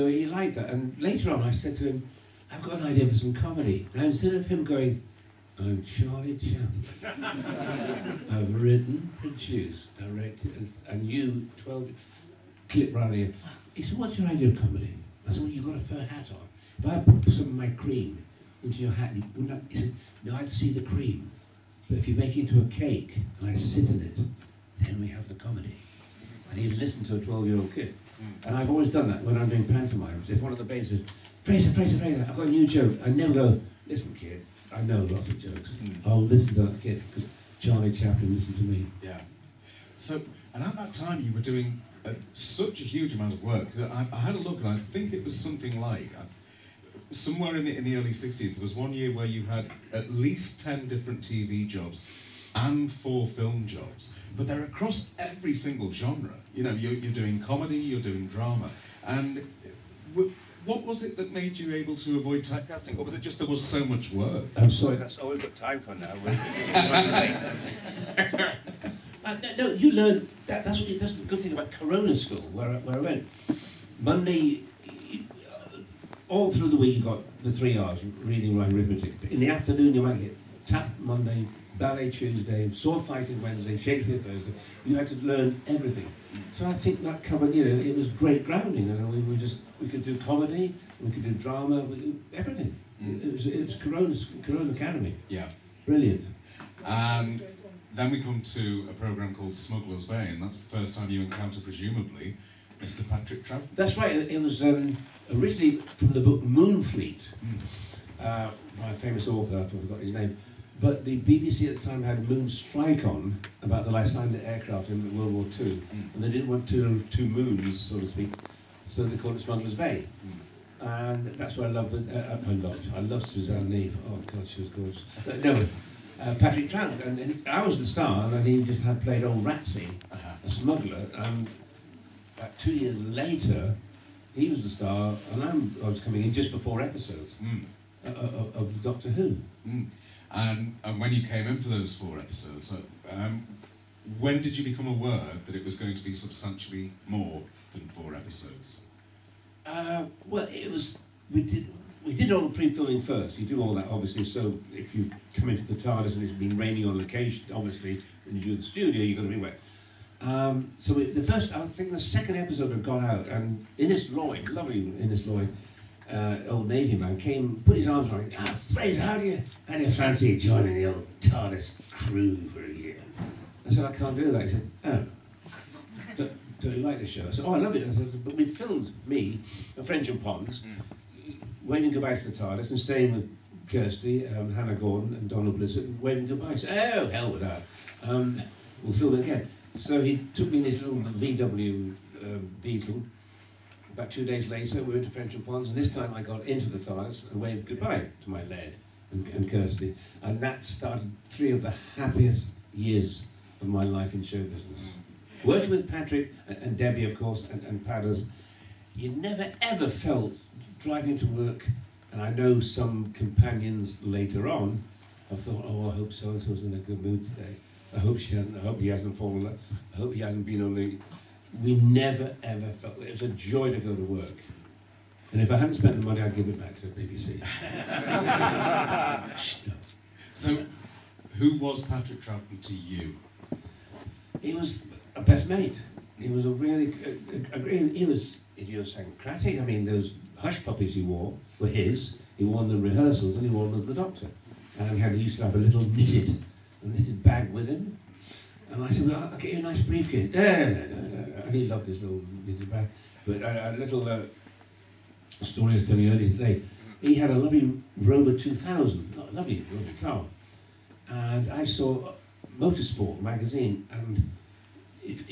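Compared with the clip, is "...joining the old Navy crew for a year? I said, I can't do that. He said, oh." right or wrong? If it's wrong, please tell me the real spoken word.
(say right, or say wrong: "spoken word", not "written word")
wrong: "TARDIS", not "Navy".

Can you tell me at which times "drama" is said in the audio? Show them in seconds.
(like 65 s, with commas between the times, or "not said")
58 s, 91 s.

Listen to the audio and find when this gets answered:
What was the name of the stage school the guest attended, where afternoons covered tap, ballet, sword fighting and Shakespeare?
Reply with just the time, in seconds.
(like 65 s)
71 s.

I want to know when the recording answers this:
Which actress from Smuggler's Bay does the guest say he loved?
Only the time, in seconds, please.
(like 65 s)
123 s.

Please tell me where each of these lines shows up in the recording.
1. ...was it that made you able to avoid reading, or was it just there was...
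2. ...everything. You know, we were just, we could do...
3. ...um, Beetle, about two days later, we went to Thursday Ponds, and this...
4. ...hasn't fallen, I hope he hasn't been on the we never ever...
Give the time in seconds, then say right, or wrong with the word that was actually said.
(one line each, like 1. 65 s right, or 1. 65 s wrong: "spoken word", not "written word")
1. 60 s wrong: "typecasting", not "reading"
2. 88 s wrong: "grounding", not "everything"
3. 192 s wrong: "Frensham", not "Thursday"
4. 218 s right.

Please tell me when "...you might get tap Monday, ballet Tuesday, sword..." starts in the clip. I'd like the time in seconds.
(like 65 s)
79 s.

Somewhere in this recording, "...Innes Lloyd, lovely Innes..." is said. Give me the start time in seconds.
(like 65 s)
163 s.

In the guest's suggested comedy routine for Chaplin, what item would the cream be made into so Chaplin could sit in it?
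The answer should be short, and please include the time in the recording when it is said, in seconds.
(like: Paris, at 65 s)
A cake, at 22 s.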